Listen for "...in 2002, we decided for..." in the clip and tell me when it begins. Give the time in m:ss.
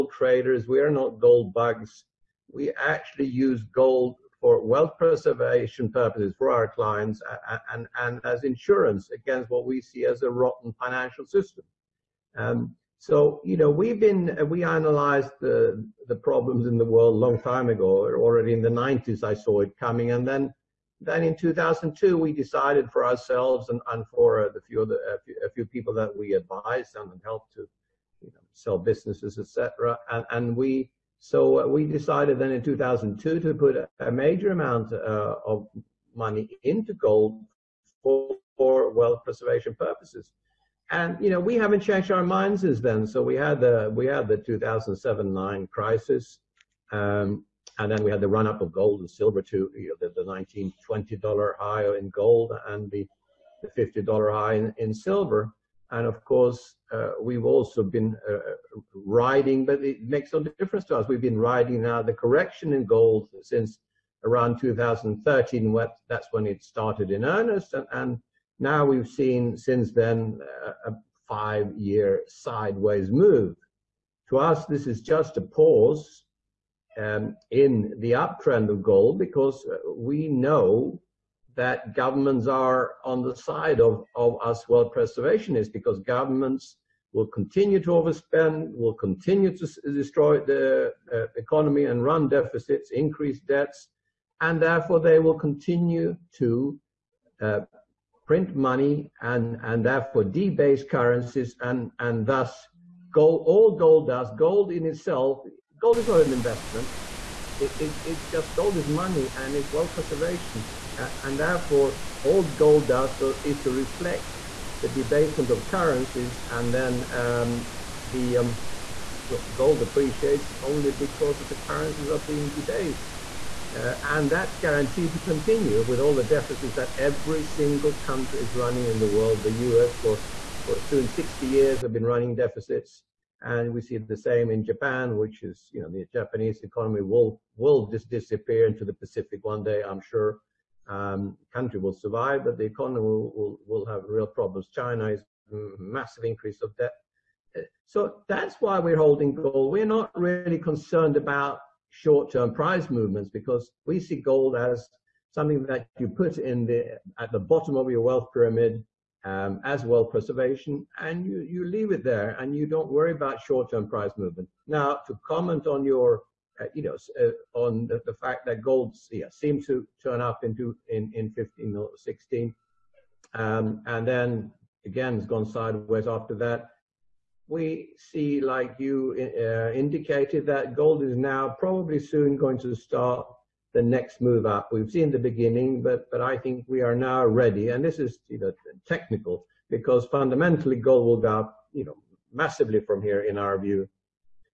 0:21.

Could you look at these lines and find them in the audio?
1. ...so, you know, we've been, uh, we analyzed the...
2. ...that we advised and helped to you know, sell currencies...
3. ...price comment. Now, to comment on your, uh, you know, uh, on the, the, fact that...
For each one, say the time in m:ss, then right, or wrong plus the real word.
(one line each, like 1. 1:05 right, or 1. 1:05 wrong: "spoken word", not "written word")
1. 0:12 right
2. 0:25 wrong: "businesses", not "currencies"
3. 2:43 wrong: "movement", not "comment".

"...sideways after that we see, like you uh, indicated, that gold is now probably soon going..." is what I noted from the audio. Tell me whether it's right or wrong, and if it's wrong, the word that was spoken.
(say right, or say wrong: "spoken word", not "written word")
right.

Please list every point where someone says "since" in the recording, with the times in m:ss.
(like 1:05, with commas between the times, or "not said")
0:42, 1:03, 1:09.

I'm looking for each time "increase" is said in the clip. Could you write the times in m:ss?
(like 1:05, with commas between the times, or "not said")
1:32, 2:26.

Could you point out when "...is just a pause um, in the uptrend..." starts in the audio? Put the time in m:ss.
1:14.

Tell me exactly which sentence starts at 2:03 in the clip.
Uh, and that's guaranteed to continue with all the deficits that every single country is running in the world.